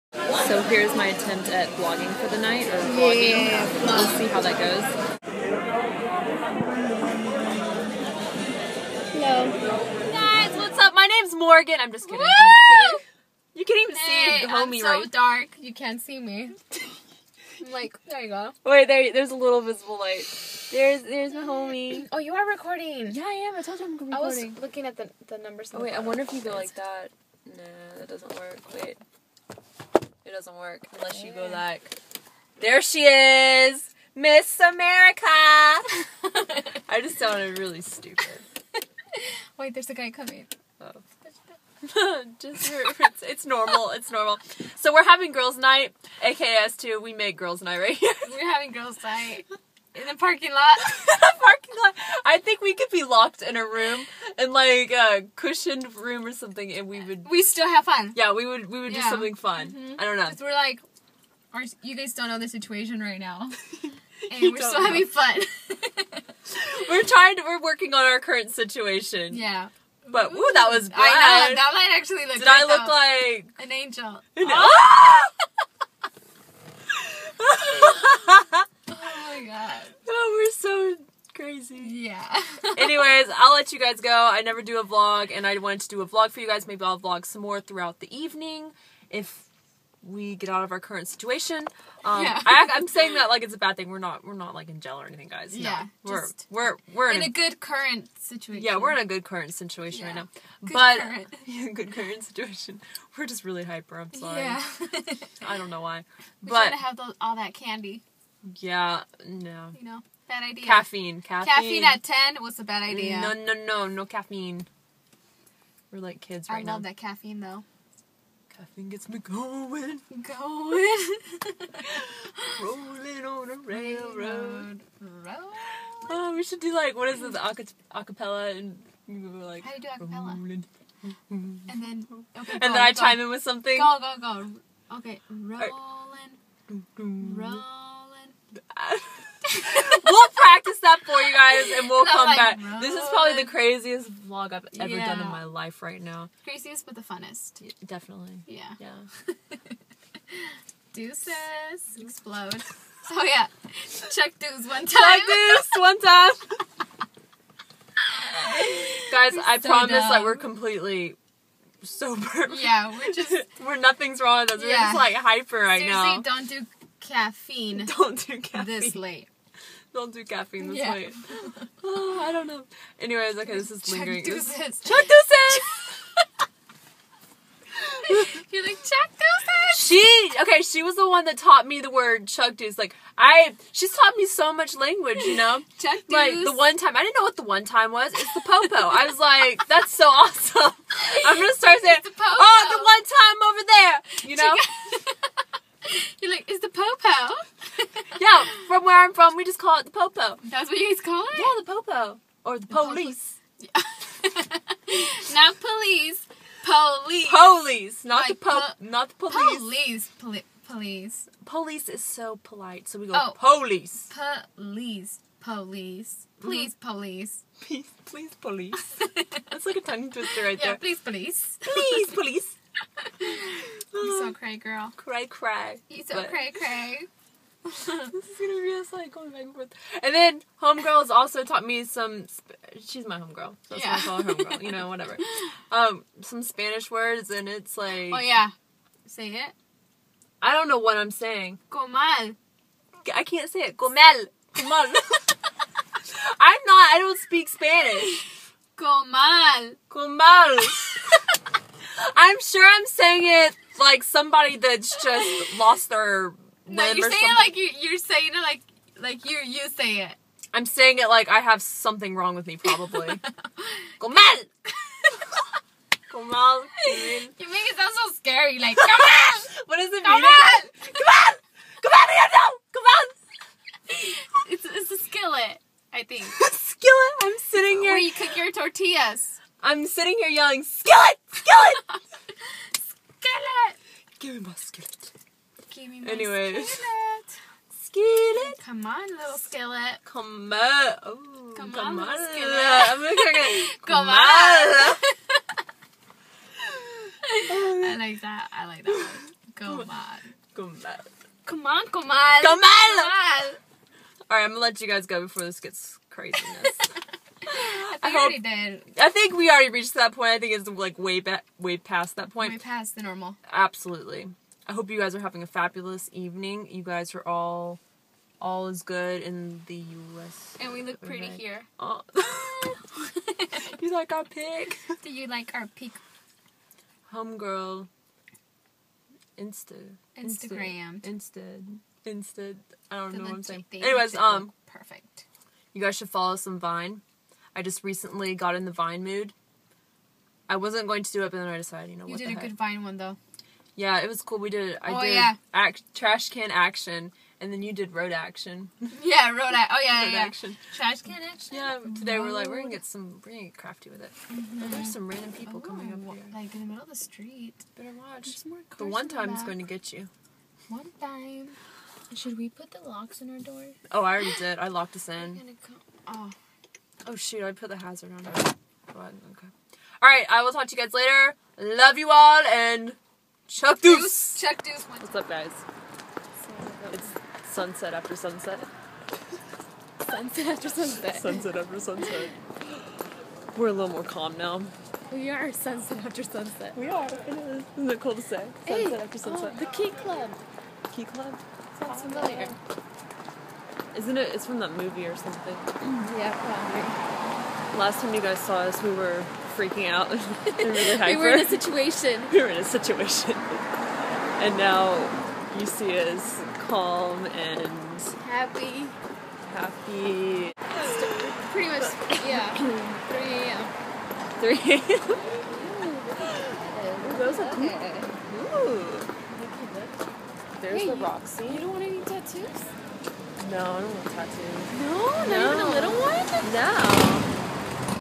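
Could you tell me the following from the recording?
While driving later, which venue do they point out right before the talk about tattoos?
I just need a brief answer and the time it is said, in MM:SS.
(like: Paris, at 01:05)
The Roxy, at 07:00.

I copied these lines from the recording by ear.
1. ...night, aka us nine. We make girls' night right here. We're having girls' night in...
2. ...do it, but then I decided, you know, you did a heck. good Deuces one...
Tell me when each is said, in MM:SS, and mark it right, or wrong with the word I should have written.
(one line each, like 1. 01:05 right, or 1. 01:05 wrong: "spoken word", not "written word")
1. 00:45 wrong: "two", not "nine"
2. 05:41 wrong: "Vine", not "Deuces".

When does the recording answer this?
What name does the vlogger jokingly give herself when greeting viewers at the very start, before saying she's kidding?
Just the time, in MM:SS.
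00:11.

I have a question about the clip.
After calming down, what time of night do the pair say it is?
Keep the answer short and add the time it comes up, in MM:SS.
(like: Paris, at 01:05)
3 a.m., at 06:54.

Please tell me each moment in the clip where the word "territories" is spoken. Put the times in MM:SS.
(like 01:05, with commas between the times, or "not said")
not said.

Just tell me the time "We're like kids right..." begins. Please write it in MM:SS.
01:55.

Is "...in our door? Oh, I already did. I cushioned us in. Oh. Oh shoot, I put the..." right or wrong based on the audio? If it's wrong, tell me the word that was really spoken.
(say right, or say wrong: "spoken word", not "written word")
wrong: "locked", not "cushioned".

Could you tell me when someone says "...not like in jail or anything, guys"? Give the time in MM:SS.
01:34.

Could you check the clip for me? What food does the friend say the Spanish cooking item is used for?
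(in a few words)
Tortillas.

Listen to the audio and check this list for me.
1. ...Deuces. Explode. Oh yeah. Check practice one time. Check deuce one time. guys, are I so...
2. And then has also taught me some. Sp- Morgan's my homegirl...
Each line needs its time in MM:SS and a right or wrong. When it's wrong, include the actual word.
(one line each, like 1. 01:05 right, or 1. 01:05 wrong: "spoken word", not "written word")
1. 02:30 wrong: "deuce", not "practice"
2. 03:50 wrong: "She", not "Morgan".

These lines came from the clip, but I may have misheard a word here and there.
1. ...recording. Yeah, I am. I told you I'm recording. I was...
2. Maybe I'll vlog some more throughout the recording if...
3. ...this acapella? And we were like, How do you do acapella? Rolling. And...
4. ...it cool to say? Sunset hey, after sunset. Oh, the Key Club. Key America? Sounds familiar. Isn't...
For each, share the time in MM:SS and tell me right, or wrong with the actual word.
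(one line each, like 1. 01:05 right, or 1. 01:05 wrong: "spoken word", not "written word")
1. 00:22 right
2. 01:26 wrong: "evening", not "recording"
3. 02:07 right
4. 06:27 wrong: "Club", not "America".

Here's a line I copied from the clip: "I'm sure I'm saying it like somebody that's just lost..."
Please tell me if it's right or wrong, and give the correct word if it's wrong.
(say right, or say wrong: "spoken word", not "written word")
right.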